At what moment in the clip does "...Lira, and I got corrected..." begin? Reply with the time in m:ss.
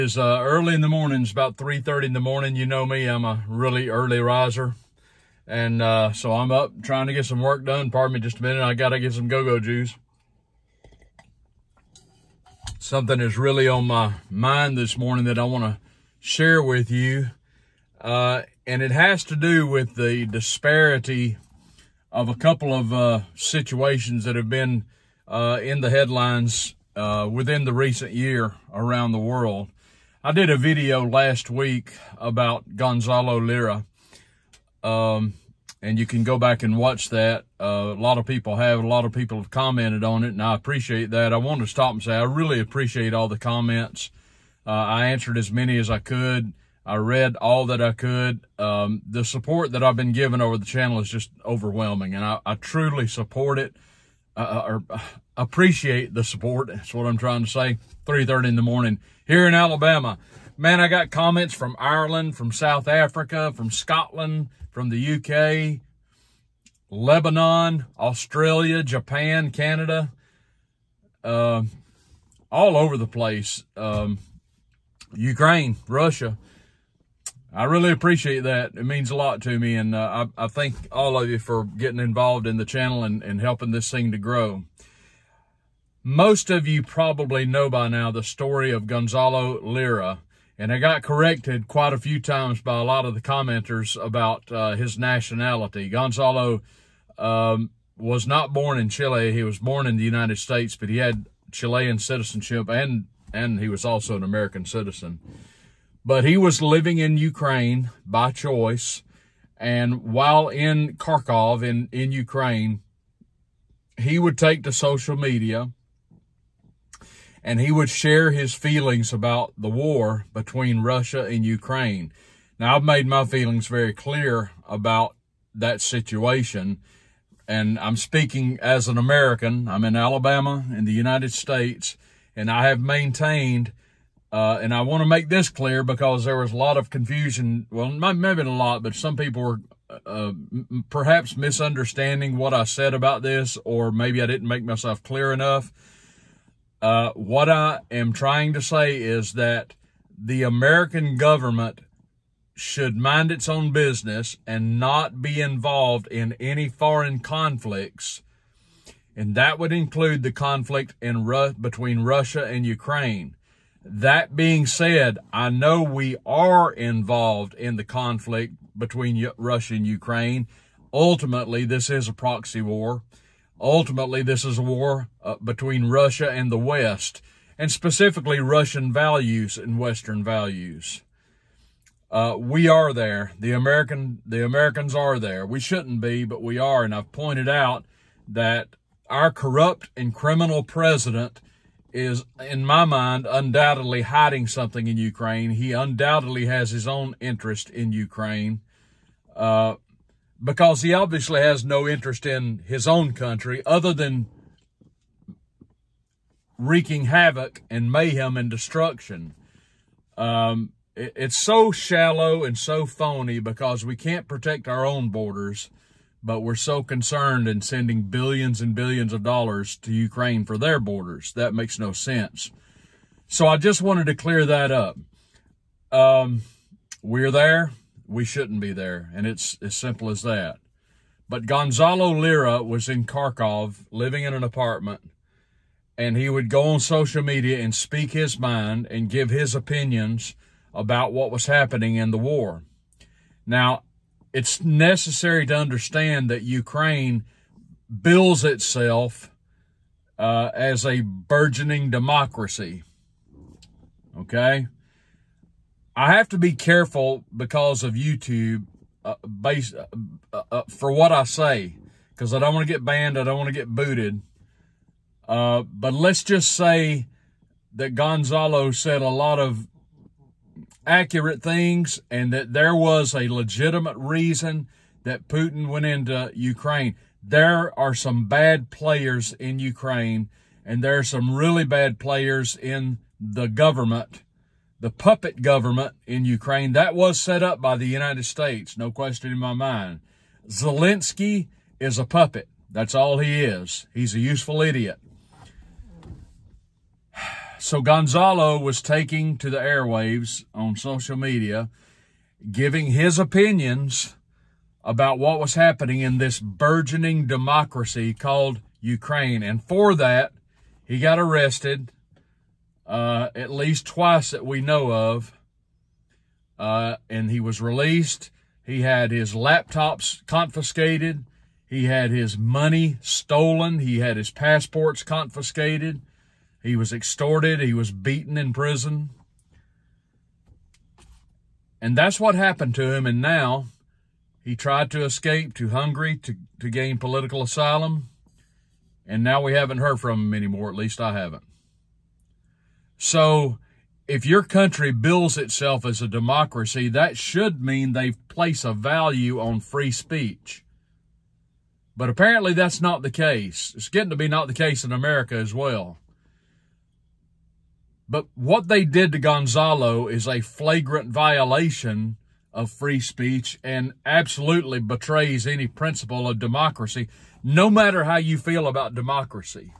1:29.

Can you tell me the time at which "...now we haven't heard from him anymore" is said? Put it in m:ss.
5:39.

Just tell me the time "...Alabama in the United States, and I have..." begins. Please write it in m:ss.
2:09.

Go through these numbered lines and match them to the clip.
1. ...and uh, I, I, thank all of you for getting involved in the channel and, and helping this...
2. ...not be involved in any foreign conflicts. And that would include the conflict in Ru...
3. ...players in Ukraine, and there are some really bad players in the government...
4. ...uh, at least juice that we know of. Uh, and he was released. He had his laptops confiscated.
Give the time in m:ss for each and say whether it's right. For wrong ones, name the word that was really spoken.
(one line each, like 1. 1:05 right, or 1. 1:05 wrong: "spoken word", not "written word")
1. 1:19 right
2. 2:34 right
3. 4:38 right
4. 5:12 wrong: "twice", not "juice".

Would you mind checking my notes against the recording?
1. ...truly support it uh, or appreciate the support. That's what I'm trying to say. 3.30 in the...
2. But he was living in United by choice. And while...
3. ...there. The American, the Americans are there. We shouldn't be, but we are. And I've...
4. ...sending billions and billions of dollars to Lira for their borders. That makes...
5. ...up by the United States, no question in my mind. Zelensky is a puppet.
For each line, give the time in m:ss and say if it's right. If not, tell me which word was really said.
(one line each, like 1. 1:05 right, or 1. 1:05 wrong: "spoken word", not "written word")
1. 0:52 right
2. 1:46 wrong: "Ukraine", not "United"
3. 3:02 right
4. 3:37 wrong: "Ukraine", not "Lira"
5. 4:47 right.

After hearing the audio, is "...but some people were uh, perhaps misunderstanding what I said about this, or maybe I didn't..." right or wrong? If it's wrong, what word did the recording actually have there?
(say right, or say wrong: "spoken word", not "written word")
right.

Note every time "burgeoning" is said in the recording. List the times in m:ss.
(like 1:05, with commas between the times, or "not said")
4:10, 5:06.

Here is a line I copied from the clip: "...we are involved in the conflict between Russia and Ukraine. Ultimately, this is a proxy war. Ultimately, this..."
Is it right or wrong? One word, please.
right.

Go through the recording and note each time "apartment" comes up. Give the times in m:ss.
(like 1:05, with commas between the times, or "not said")
3:54.